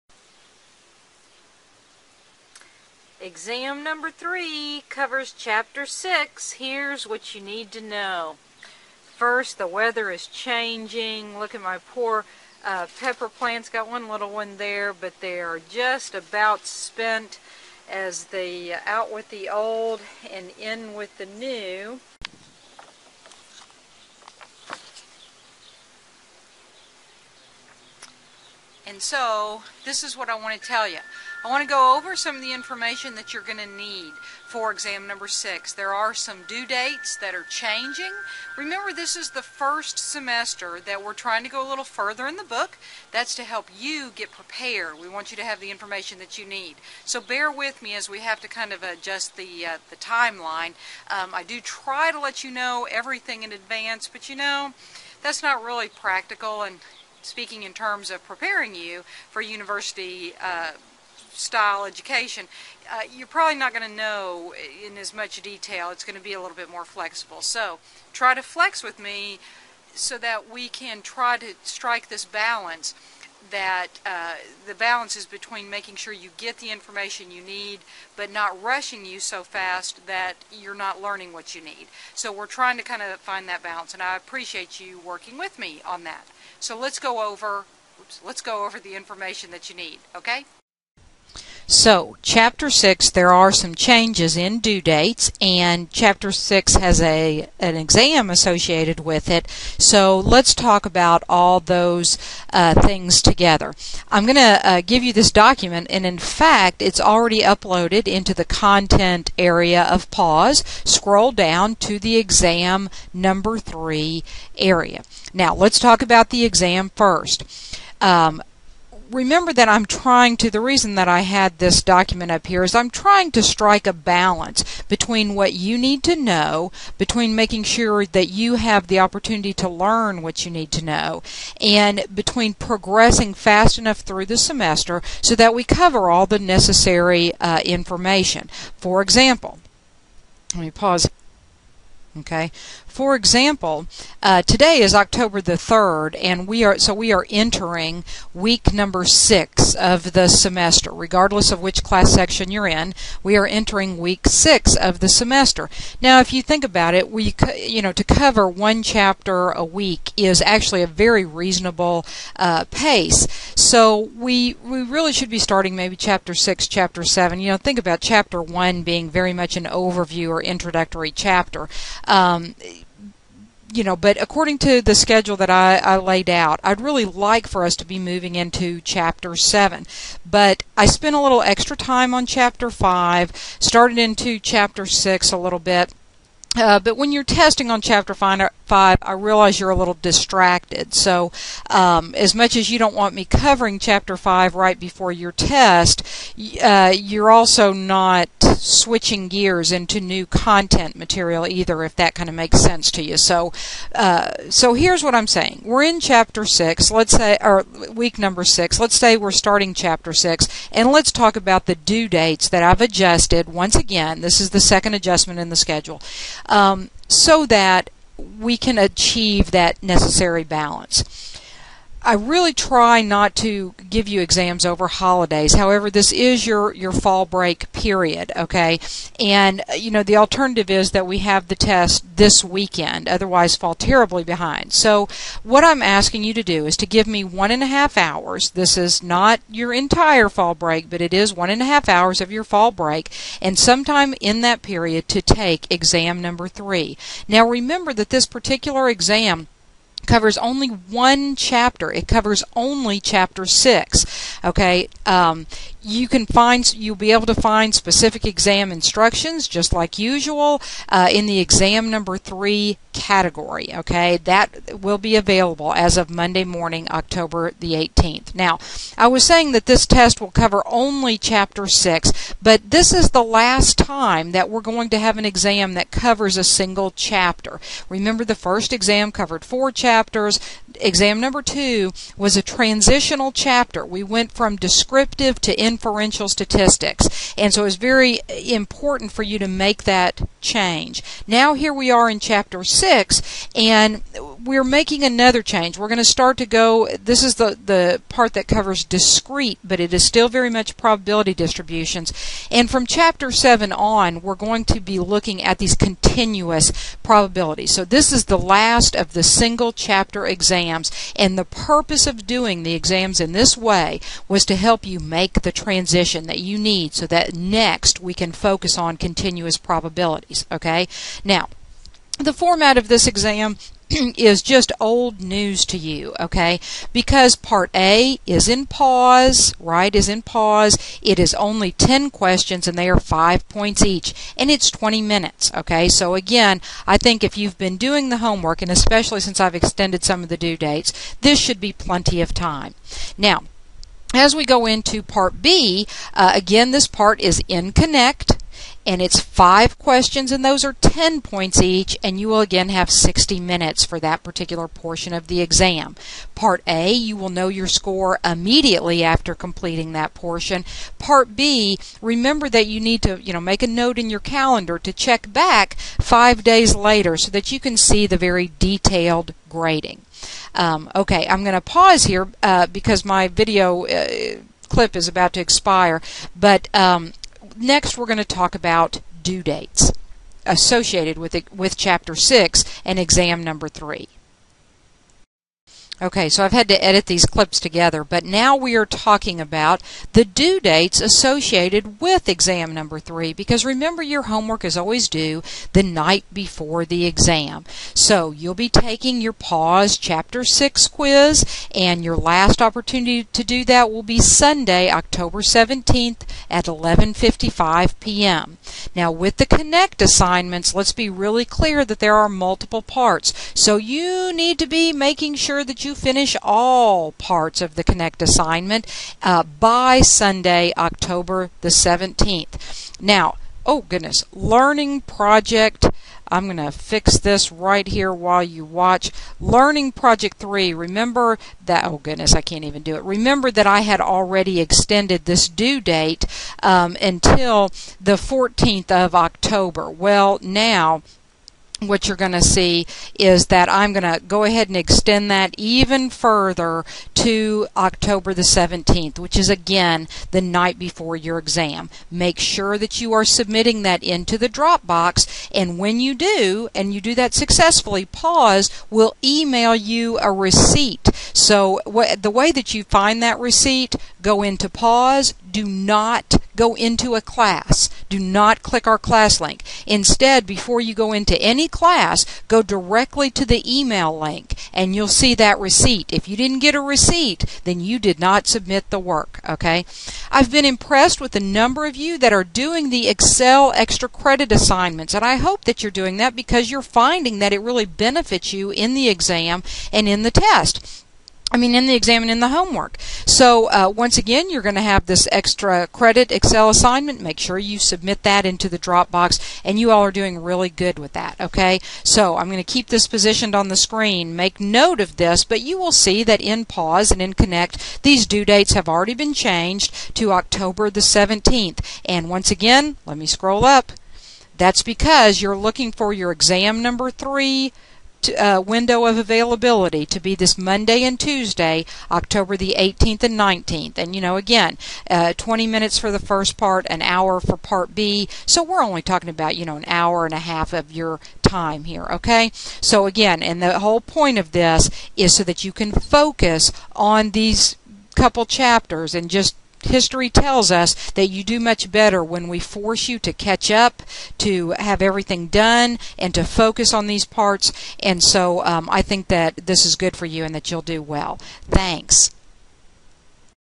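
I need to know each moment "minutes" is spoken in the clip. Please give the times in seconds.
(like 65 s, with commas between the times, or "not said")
335 s, 353 s, 525 s.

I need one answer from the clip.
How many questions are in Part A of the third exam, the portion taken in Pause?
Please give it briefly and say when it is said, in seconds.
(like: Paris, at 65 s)
10, at 331 s.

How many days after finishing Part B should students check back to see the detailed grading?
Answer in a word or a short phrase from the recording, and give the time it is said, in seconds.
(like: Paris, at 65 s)
5, at 366 s.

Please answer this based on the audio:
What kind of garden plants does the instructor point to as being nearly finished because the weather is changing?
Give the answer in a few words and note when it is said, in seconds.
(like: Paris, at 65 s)
pepper plants, at 12 s.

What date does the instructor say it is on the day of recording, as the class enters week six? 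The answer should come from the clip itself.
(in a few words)
October 3rd.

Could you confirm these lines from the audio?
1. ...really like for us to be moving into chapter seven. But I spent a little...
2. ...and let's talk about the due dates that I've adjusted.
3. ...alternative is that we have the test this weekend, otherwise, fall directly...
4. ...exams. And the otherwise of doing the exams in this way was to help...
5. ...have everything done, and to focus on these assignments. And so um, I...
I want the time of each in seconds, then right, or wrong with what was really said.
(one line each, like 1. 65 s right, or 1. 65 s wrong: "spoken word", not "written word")
1. 176 s right
2. 210 s right
3. 230 s wrong: "terribly", not "directly"
4. 310 s wrong: "purpose", not "otherwise"
5. 544 s wrong: "parts", not "assignments".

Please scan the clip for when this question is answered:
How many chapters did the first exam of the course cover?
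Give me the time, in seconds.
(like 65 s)
279 s.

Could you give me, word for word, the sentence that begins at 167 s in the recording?
You know, think about chapter one being very much an overview or introductory chapter.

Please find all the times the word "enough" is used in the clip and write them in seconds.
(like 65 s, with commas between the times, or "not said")
133 s.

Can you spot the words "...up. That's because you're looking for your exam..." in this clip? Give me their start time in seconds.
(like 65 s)
513 s.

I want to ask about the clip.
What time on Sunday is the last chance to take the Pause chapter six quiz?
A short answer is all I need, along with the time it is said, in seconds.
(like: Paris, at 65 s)
11:55 p.m., at 406 s.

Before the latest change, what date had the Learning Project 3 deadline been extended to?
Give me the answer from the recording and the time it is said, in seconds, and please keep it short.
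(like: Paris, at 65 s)
October 14, at 437 s.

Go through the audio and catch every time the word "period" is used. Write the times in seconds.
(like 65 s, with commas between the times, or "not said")
227 s, 244 s.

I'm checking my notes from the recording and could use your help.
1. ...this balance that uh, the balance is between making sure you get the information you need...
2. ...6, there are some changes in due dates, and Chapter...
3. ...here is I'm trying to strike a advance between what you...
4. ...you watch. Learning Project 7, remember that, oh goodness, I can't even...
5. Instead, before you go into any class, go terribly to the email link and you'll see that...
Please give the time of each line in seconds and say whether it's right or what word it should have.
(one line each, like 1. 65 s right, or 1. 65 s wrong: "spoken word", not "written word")
1. 72 s right
2. 92 s right
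3. 122 s wrong: "balance", not "advance"
4. 428 s wrong: "3", not "7"
5. 469 s wrong: "directly", not "terribly".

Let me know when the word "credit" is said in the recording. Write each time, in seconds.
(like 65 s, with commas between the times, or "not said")
484 s, 495 s.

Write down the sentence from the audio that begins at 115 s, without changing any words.
Now, let's talk about the exam first.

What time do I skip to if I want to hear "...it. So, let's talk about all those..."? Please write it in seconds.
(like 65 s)
99 s.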